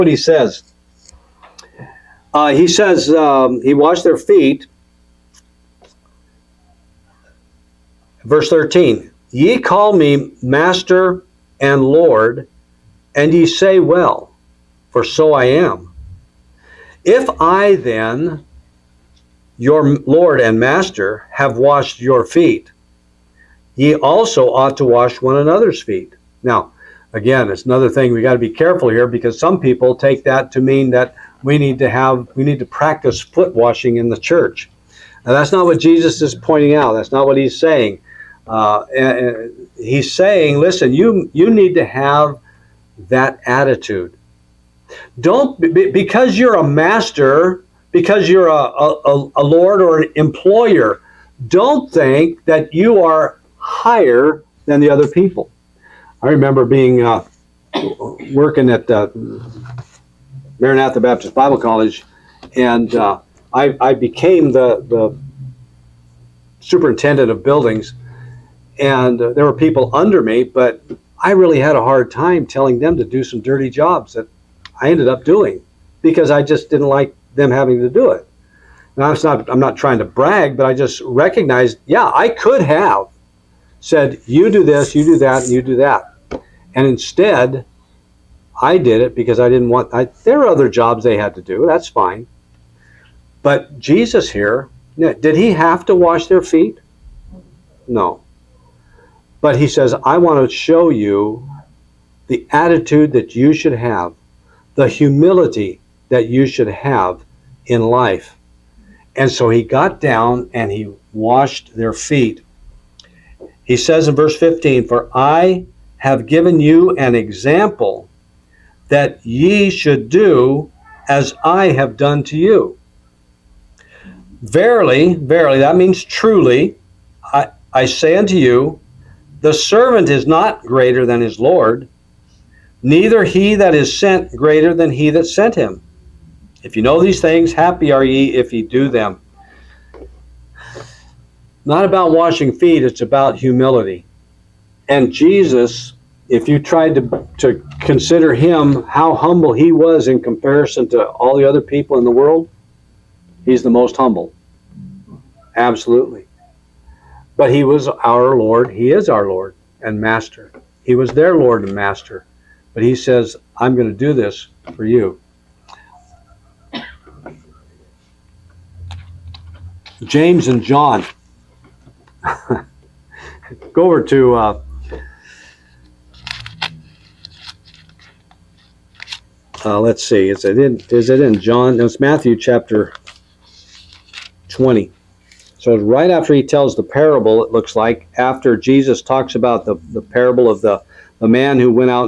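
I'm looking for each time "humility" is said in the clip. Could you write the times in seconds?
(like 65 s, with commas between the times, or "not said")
104 s, 143 s.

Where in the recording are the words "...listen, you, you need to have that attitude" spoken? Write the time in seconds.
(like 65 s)
40 s.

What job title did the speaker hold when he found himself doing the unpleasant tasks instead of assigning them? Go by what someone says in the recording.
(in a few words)
Superintendent of buildings.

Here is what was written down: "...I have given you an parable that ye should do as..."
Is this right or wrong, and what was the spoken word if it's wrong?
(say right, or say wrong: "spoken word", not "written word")
wrong: "example", not "parable".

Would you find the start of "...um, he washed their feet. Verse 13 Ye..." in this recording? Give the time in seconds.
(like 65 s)
3 s.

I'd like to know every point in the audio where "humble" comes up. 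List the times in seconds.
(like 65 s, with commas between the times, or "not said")
149 s, 153 s.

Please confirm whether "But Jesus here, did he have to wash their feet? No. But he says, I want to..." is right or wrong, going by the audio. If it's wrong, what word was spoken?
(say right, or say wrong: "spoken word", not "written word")
right.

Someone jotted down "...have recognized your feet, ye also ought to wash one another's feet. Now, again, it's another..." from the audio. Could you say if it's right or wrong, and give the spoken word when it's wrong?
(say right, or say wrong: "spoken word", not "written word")
wrong: "washed", not "recognized".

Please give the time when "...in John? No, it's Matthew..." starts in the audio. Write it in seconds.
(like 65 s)
181 s.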